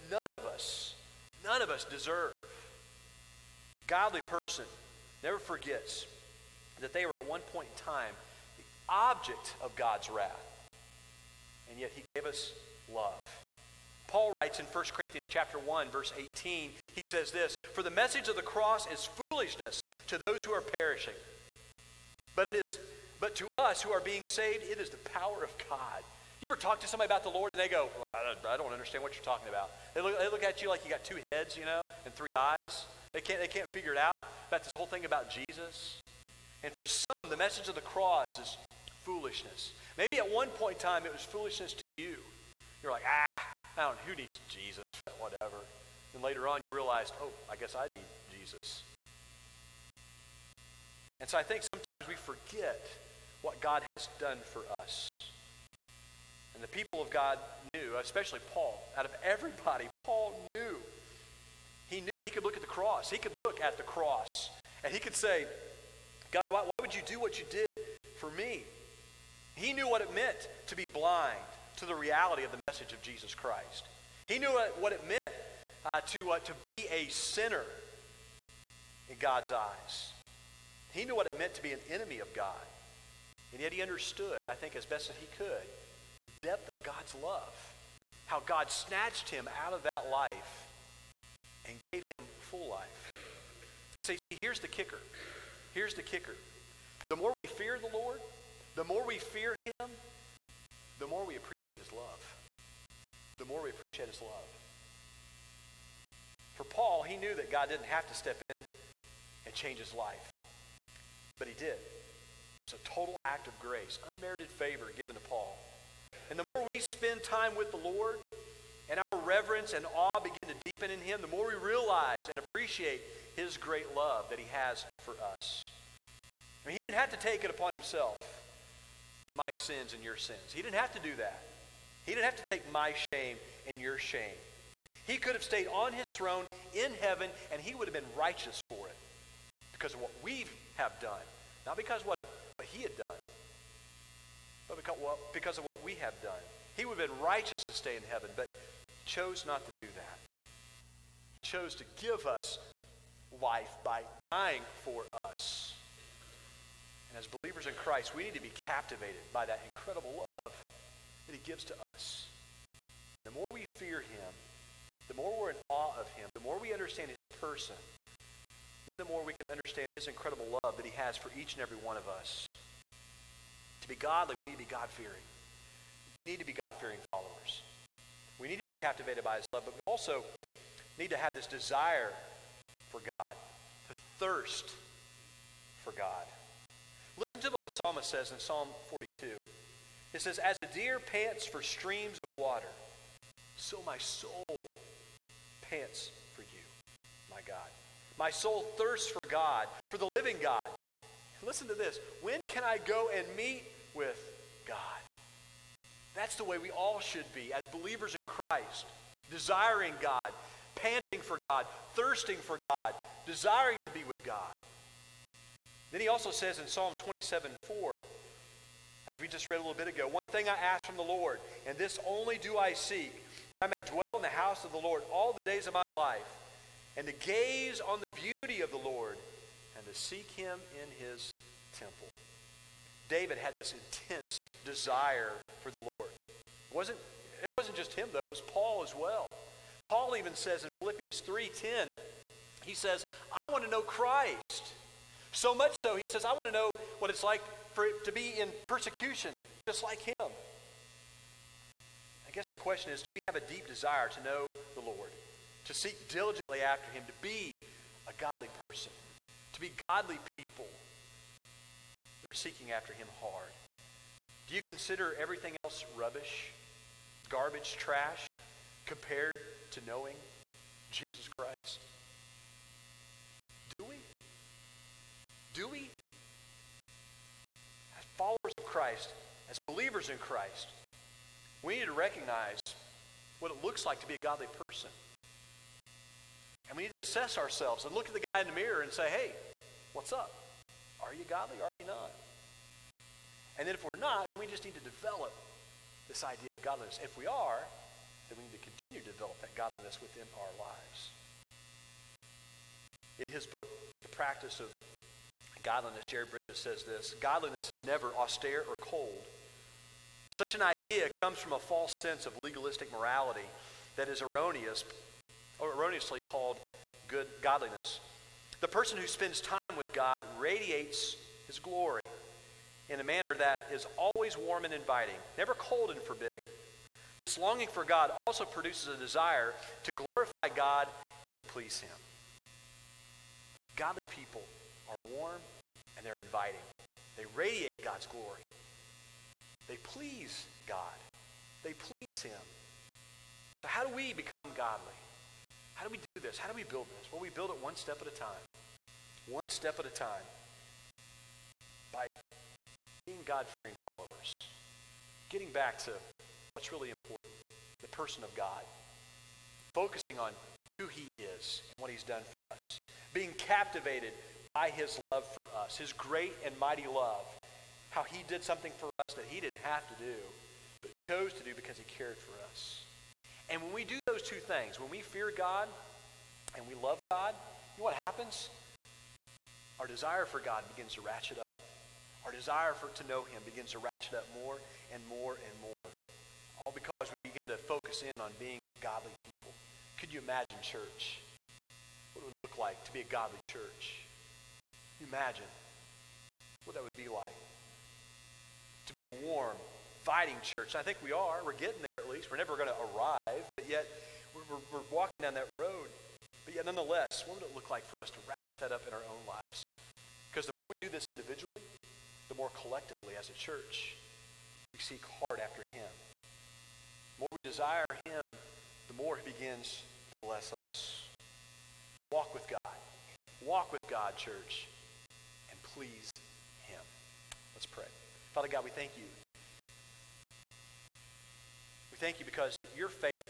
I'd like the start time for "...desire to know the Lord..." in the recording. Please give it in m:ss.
4:13.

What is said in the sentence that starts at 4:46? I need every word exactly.
And we need to assess ourselves and look at the guy in the mirror and say, hey, what's up?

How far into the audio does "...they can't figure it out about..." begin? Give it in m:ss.
0:33.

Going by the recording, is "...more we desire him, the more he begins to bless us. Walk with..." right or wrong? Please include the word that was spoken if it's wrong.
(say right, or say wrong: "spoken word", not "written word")
right.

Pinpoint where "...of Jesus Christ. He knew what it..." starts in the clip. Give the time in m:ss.
1:12.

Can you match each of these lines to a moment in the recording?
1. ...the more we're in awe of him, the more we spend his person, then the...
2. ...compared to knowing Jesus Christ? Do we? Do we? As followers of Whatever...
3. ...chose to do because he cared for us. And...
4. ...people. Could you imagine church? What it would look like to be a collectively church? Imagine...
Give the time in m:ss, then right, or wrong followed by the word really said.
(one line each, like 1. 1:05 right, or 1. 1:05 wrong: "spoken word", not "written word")
1. 2:45 wrong: "understand", not "spend"
2. 4:28 wrong: "Christ", not "Whatever"
3. 6:10 right
4. 6:29 wrong: "godly", not "collectively".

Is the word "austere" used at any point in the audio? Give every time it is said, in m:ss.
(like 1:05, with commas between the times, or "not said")
5:08.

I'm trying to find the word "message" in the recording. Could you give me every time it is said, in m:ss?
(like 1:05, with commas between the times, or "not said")
0:17, 0:37, 1:12.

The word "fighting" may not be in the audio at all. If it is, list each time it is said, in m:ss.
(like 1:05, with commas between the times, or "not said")
6:40.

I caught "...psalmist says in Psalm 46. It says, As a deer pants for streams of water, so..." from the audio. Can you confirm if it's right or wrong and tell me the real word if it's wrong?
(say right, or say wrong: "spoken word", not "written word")
wrong: "42", not "46".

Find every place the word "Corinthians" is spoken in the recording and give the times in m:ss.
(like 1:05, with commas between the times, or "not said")
0:14.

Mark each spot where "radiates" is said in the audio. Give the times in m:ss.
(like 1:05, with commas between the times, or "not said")
5:20, 5:37.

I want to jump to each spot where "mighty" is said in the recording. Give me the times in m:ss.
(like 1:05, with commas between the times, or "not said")
6:06.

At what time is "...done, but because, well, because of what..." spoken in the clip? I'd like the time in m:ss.
2:22.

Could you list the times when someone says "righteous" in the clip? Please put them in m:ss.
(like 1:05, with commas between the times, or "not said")
2:18, 2:27.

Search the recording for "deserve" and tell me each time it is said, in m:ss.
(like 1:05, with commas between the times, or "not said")
0:01.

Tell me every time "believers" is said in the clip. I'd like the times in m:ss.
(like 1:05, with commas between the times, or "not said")
2:37, 3:27, 4:39.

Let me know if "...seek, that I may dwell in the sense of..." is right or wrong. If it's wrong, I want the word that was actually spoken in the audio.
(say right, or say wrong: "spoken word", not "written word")
wrong: "house", not "sense".